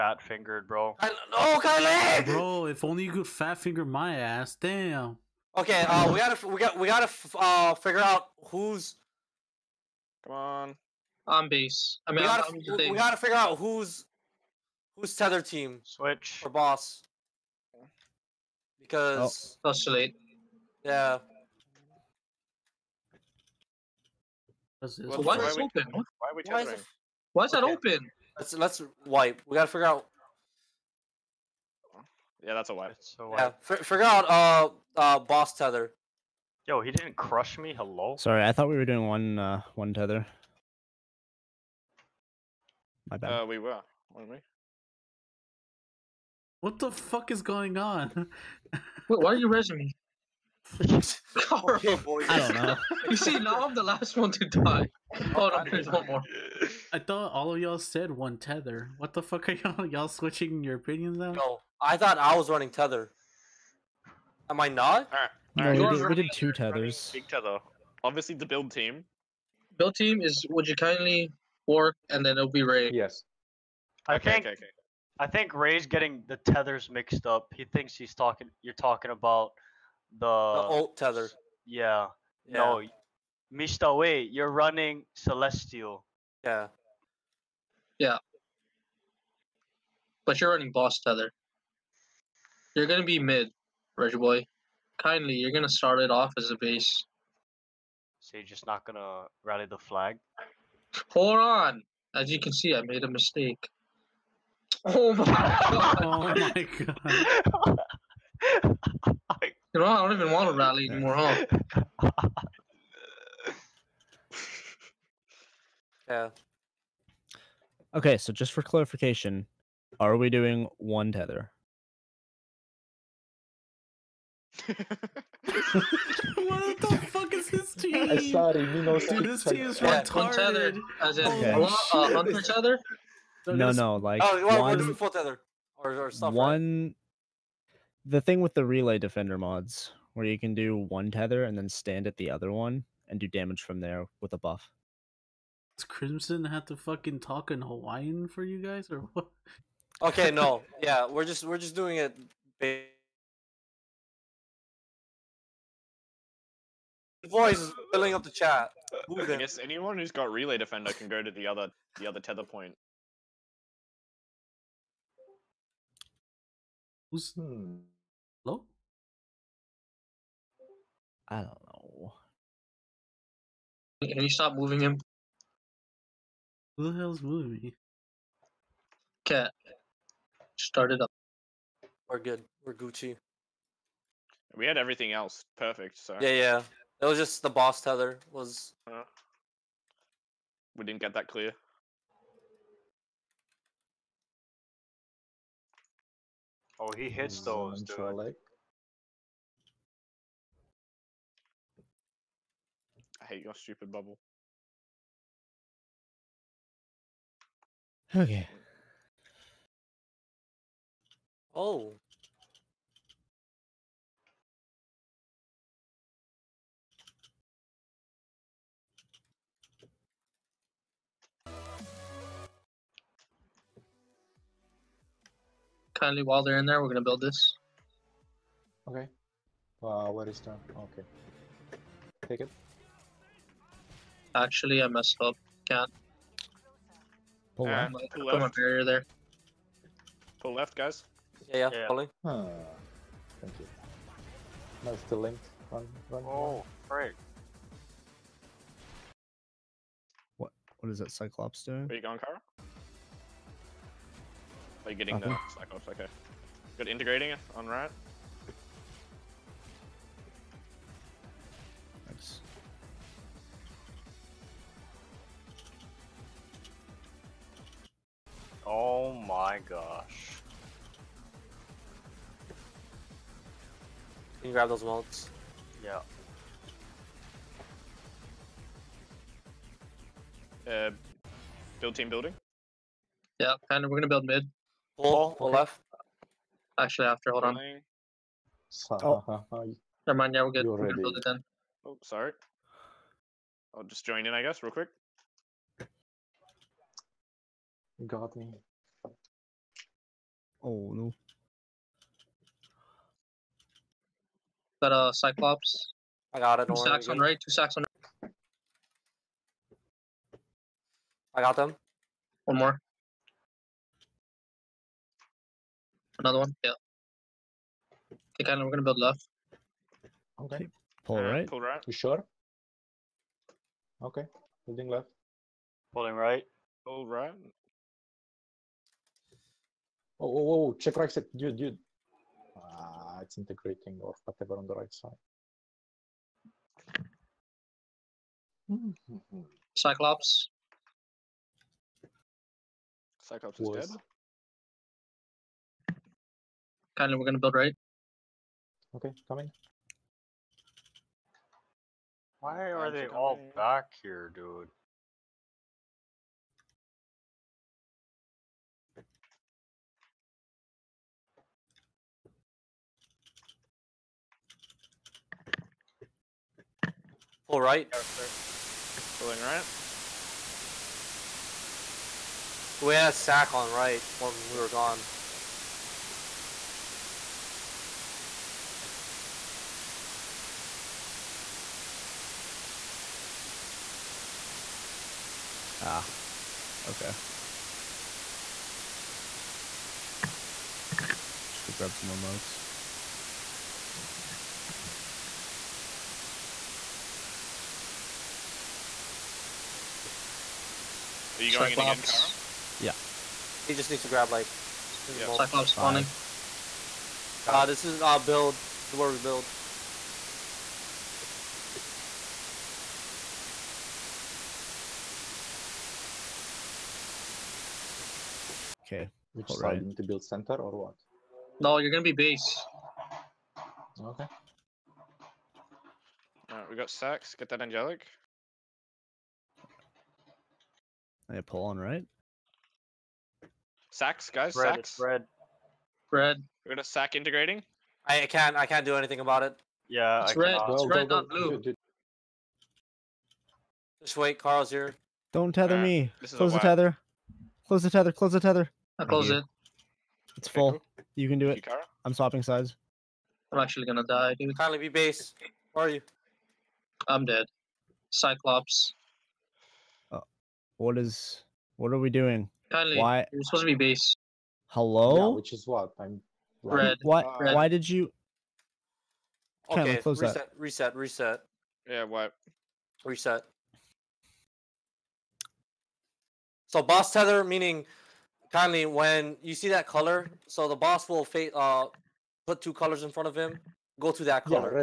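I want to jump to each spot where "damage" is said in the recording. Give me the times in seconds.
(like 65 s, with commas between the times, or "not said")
143 s.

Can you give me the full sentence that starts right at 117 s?
Okay, so just for clarification, are we doing one tether?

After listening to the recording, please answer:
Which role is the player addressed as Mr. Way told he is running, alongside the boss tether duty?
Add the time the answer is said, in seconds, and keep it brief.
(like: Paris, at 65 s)
Celestial, at 85 s.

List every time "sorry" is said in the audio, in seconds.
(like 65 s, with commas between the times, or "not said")
38 s, 128 s, 292 s.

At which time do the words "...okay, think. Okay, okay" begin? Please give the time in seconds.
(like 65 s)
74 s.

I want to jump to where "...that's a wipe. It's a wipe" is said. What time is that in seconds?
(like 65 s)
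32 s.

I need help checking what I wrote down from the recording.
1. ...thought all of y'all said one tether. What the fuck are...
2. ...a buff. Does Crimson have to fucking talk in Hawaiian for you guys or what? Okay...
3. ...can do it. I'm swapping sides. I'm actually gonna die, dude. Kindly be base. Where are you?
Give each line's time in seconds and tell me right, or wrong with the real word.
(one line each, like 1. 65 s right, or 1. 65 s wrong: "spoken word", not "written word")
1. 56 s right
2. 144 s right
3. 451 s right.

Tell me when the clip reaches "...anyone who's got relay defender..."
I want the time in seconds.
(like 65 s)
159 s.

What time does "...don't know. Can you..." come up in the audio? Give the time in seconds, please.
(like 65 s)
171 s.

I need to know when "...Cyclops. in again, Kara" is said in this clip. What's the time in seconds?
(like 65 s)
401 s.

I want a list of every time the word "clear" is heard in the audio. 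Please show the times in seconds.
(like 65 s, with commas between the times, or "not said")
191 s.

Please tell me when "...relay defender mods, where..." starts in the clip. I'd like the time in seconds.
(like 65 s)
138 s.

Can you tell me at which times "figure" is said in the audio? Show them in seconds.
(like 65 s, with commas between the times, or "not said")
7 s, 13 s, 29 s.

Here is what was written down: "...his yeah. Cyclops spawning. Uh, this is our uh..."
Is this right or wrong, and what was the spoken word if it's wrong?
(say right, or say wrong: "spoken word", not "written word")
right.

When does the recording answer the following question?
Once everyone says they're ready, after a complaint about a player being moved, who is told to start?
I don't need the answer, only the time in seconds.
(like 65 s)
179 s.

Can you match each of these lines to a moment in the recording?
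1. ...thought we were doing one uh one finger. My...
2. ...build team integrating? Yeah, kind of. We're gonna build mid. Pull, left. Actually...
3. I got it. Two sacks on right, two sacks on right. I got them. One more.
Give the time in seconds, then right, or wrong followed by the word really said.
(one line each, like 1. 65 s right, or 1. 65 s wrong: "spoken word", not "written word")
1. 38 s wrong: "tether", not "finger"
2. 281 s wrong: "building", not "integrating"
3. 306 s right.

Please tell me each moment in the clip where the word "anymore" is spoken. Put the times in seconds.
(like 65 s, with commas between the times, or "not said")
110 s.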